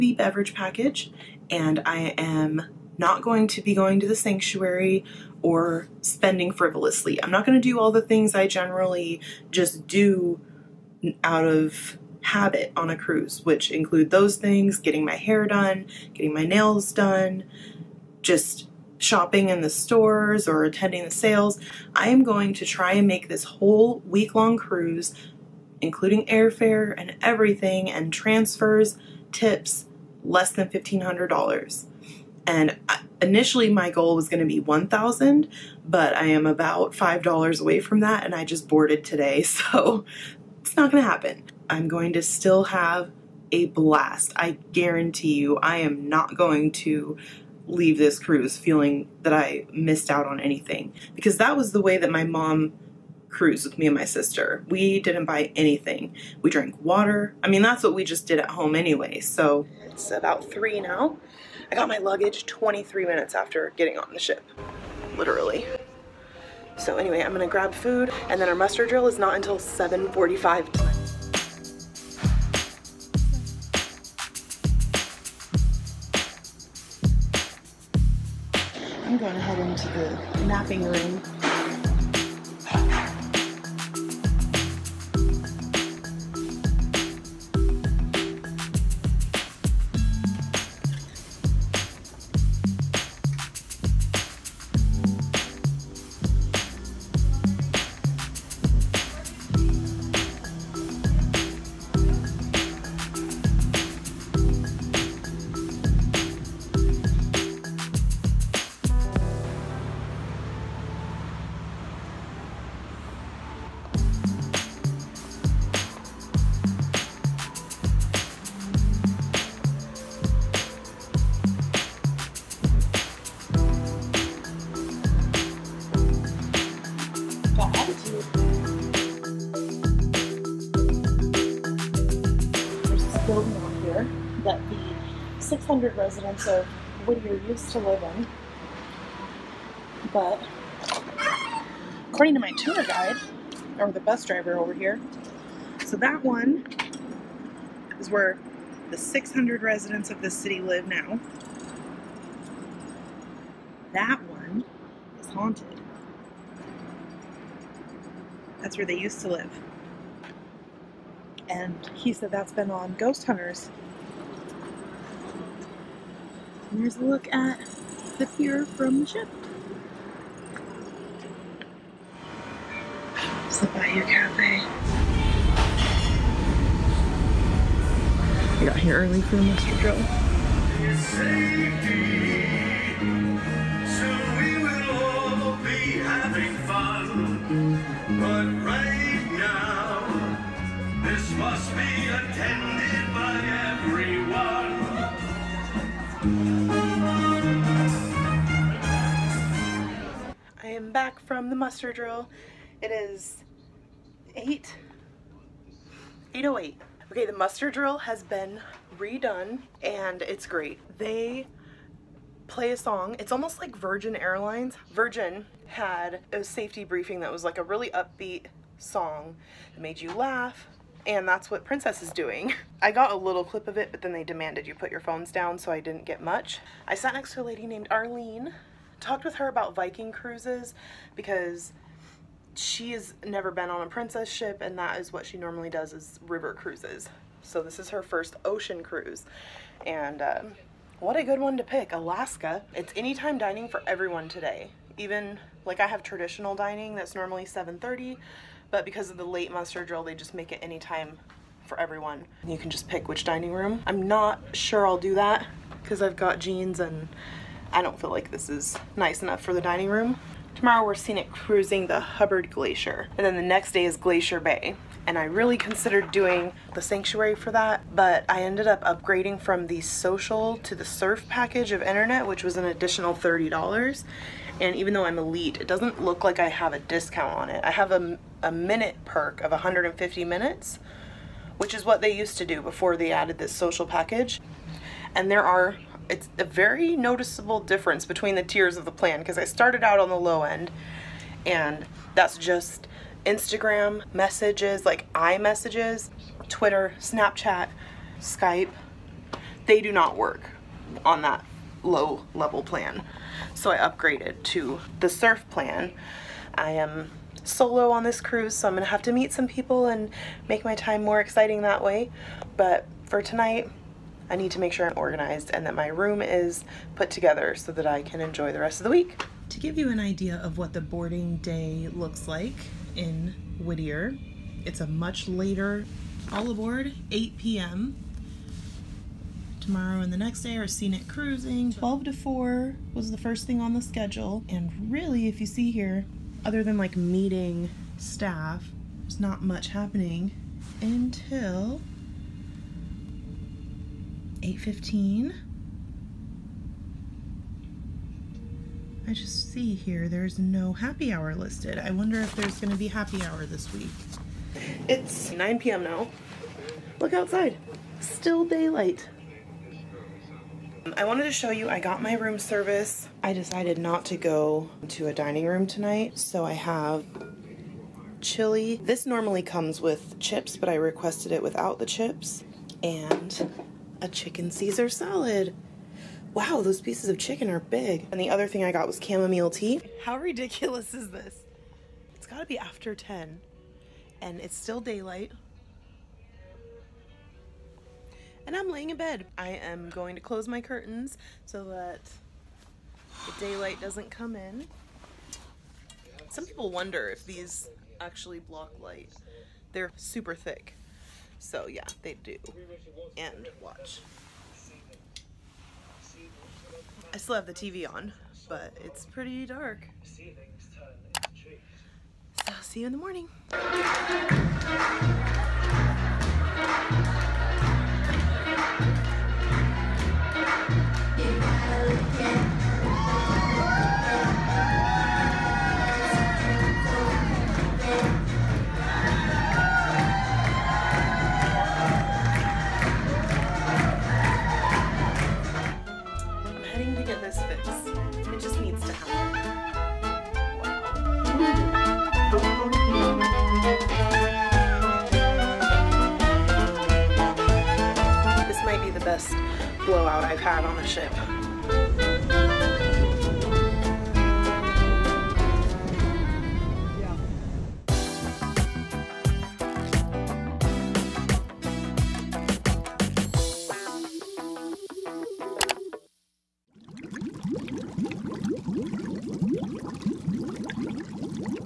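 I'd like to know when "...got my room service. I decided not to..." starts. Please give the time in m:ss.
6:01.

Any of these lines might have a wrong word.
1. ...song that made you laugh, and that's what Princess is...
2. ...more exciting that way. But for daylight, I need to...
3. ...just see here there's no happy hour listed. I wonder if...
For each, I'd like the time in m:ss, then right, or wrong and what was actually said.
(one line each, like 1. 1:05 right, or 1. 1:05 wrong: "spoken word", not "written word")
1. 3:38 right
2. 5:11 wrong: "tonight", not "daylight"
3. 5:49 right.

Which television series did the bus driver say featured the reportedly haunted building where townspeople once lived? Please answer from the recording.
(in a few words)
Ghost Hunters.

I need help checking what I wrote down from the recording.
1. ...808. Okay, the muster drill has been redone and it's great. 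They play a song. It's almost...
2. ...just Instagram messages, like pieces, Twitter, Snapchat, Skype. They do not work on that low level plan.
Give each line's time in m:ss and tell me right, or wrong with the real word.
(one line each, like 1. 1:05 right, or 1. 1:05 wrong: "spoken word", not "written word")
1. 3:26 right
2. 4:52 wrong: "iMessages", not "pieces".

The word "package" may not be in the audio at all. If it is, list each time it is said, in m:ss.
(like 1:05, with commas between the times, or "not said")
0:00, 4:31, 4:43.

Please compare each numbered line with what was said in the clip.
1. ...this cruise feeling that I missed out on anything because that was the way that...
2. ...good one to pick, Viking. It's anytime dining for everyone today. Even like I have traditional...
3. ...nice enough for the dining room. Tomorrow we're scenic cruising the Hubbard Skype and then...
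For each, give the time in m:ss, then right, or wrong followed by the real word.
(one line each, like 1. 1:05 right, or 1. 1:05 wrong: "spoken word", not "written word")
1. 0:47 right
2. 4:01 wrong: "Alaska", not "Viking"
3. 4:18 wrong: "Glacier", not "Skype".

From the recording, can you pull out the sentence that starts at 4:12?
You can just pick which dining room.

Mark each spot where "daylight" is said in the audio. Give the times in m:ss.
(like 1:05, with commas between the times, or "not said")
5:58, 6:24, 6:33.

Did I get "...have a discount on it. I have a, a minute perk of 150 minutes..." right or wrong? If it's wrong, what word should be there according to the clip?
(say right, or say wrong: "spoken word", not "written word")
right.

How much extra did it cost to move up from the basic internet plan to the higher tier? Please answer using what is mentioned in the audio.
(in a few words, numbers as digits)
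$30.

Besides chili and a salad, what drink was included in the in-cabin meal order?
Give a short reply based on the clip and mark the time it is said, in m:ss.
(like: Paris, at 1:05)
chamomile tea, at 6:19.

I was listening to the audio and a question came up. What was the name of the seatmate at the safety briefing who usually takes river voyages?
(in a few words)
Arlene.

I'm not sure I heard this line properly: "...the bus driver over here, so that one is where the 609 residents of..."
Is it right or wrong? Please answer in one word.
wrong.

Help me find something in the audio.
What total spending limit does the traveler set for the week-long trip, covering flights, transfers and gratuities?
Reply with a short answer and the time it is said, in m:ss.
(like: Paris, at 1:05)
$1,500, at 0:30.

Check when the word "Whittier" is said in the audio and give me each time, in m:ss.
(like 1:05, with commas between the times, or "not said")
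2:17, 5:23.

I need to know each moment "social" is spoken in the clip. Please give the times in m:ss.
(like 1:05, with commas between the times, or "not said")
4:29, 4:43.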